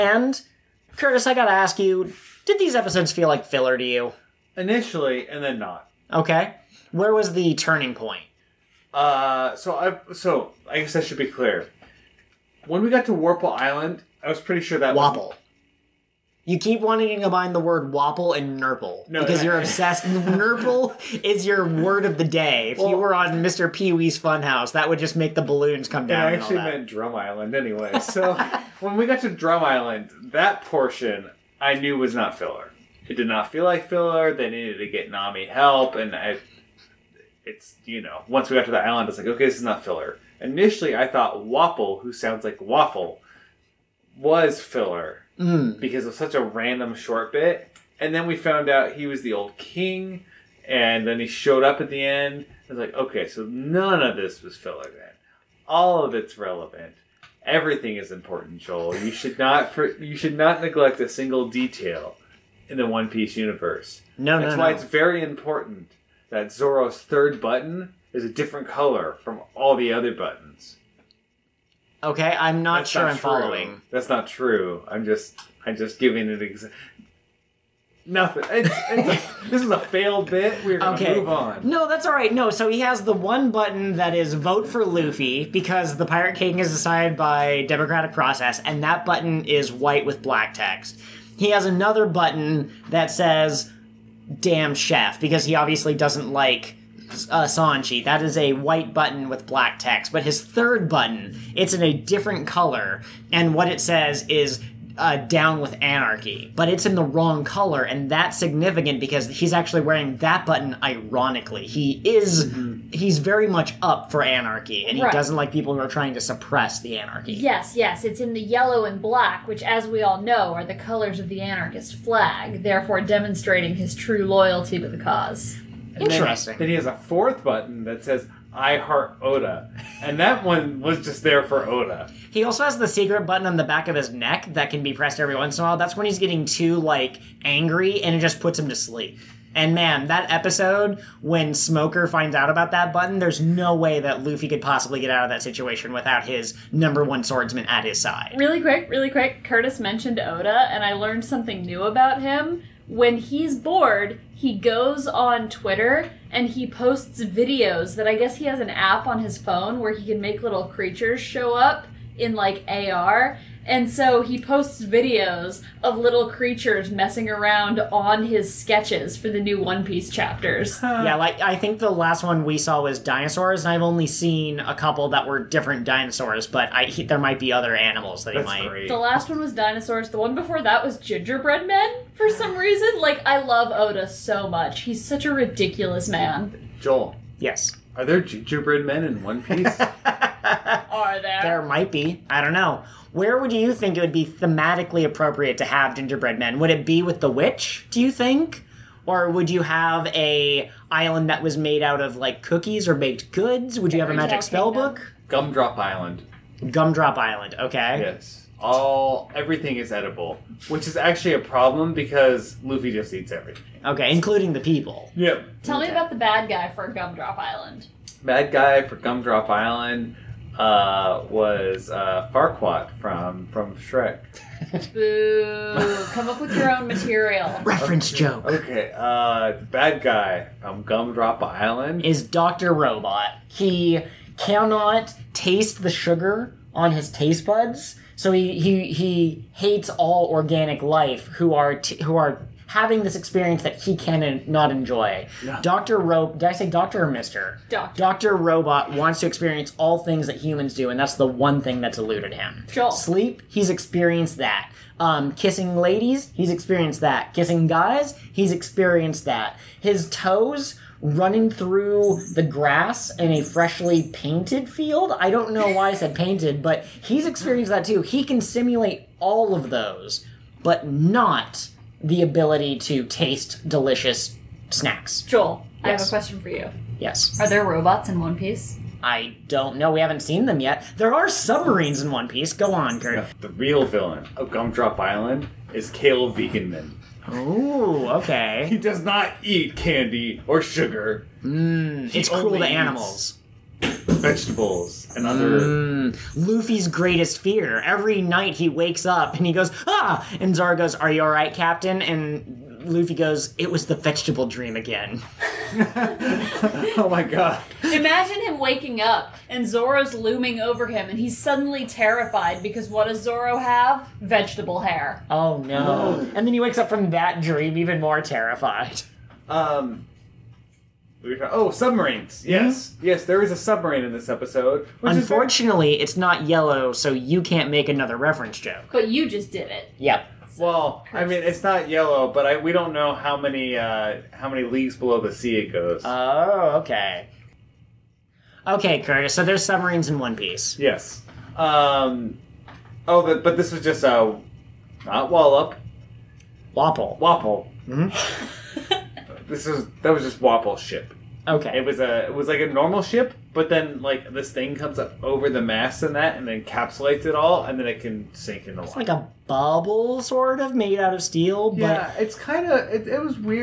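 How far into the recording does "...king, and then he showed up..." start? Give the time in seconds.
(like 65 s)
49 s.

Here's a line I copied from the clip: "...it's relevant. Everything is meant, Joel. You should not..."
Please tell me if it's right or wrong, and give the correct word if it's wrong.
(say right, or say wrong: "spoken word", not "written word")
wrong: "important", not "meant".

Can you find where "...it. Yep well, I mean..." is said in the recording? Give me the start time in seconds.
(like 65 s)
329 s.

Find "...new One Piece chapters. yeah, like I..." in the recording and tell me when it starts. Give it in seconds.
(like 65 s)
169 s.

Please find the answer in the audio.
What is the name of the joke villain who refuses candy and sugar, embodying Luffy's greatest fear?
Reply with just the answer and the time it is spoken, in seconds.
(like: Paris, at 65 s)
Kale Veganman, at 285 s.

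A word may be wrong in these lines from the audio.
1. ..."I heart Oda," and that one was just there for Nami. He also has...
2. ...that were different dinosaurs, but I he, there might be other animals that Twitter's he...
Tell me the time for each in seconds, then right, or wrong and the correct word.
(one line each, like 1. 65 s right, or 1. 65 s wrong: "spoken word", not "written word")
1. 128 s wrong: "Oda", not "Nami"
2. 175 s wrong: "That", not "Twitter".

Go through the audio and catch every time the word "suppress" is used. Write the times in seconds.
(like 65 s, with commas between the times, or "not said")
116 s.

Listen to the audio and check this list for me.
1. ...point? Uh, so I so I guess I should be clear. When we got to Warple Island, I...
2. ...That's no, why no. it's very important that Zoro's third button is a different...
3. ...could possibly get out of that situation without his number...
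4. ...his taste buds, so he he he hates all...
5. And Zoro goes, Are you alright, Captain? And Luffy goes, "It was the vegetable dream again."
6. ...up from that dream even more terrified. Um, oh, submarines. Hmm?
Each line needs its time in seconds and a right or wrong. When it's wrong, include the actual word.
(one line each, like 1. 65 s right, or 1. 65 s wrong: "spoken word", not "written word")
1. 7 s right
2. 64 s right
3. 144 s right
4. 236 s right
5. 300 s right
6. 316 s right.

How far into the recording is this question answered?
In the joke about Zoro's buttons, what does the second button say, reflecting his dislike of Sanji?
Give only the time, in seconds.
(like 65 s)
94 s.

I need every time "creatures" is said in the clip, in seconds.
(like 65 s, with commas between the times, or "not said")
160 s, 166 s.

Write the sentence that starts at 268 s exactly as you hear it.
He can simulate all of those, but not the ability to taste delicious snacks.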